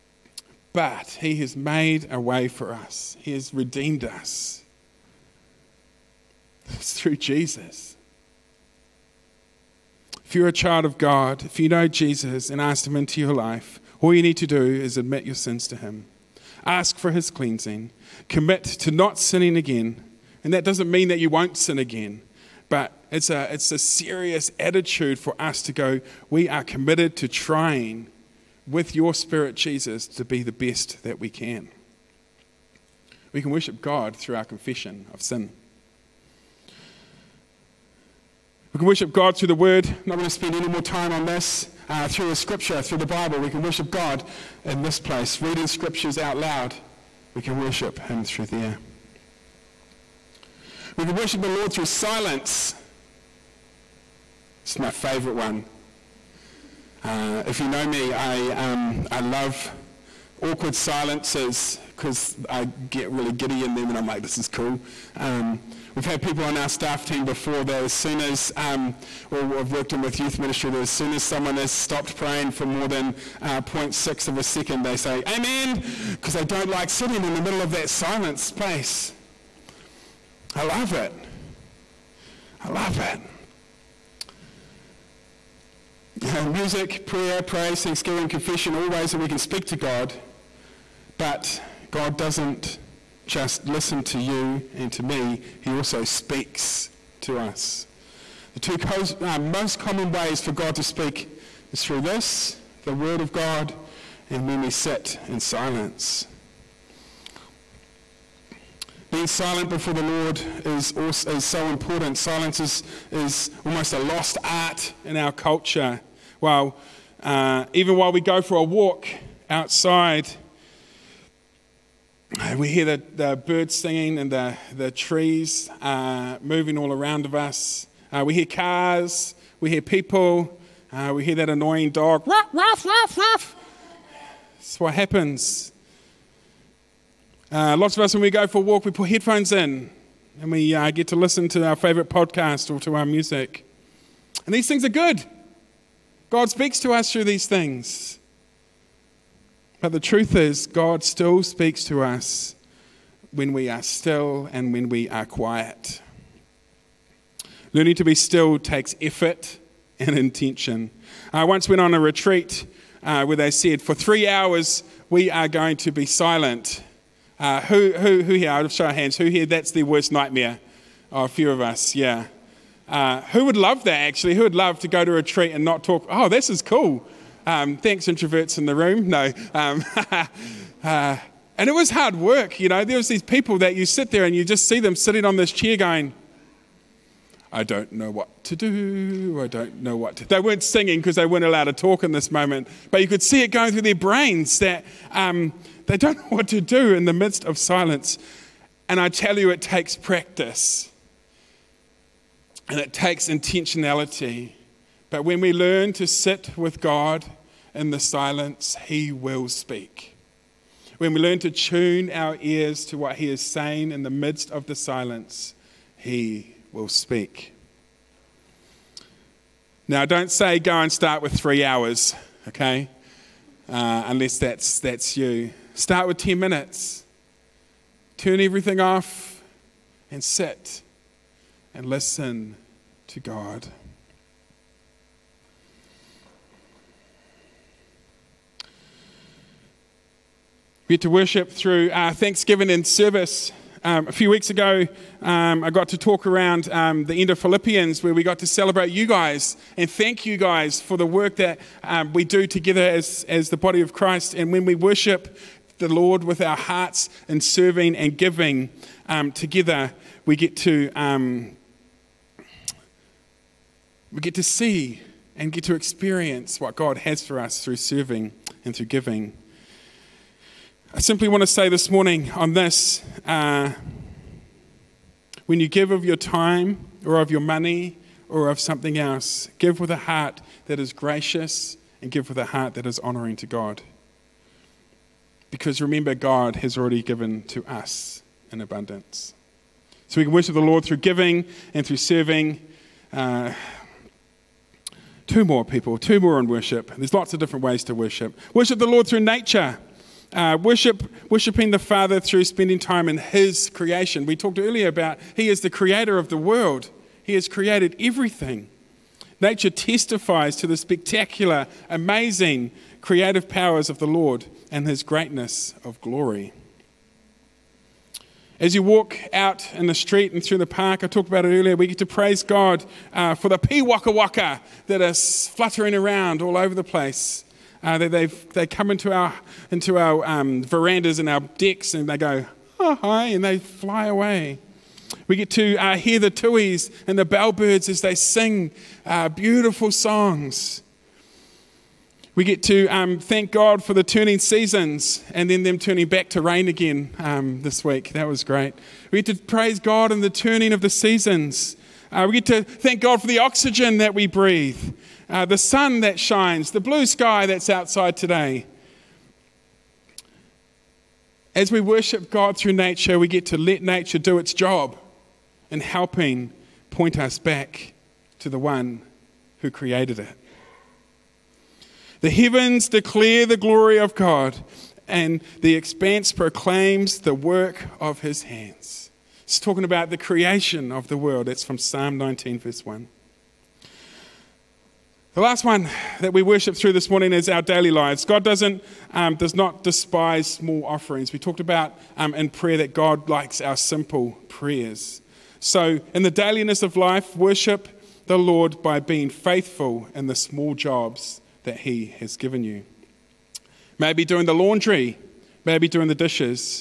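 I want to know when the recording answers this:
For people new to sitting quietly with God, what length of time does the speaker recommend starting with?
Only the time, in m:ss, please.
3:46.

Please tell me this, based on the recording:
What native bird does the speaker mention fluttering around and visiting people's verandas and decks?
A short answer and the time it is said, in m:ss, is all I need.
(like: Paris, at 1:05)
piwakawaka, at 5:23.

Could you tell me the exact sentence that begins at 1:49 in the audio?
Being silent before the Lord is, also, is so important.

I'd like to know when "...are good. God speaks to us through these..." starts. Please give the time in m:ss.
2:24.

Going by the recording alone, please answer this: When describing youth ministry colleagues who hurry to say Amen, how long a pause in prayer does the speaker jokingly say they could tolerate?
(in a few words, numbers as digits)
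0.6 of a second.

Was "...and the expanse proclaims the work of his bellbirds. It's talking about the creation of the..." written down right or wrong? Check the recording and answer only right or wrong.
wrong.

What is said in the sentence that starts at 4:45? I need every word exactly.
Because remember, God has already given to us in abundance.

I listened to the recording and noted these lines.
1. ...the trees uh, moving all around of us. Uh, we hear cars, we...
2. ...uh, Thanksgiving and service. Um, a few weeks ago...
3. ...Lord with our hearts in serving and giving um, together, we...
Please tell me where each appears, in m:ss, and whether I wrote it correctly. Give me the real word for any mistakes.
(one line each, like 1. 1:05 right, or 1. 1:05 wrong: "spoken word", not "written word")
1. 2:04 right
2. 4:01 right
3. 4:15 right.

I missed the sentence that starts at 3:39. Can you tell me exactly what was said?
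Now, don't say go and start with three hours, okay?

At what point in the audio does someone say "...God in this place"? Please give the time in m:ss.
0:43.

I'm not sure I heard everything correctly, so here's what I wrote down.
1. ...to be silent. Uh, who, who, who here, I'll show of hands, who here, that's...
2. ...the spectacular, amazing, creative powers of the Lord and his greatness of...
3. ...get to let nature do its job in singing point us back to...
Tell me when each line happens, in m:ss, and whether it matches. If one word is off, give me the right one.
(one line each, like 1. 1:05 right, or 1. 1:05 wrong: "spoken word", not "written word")
1. 2:45 right
2. 5:10 right
3. 6:03 wrong: "helping", not "singing".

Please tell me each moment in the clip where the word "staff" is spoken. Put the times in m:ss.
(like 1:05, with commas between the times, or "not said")
1:06.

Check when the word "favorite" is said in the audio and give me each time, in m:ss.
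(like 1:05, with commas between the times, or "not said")
0:54, 2:21.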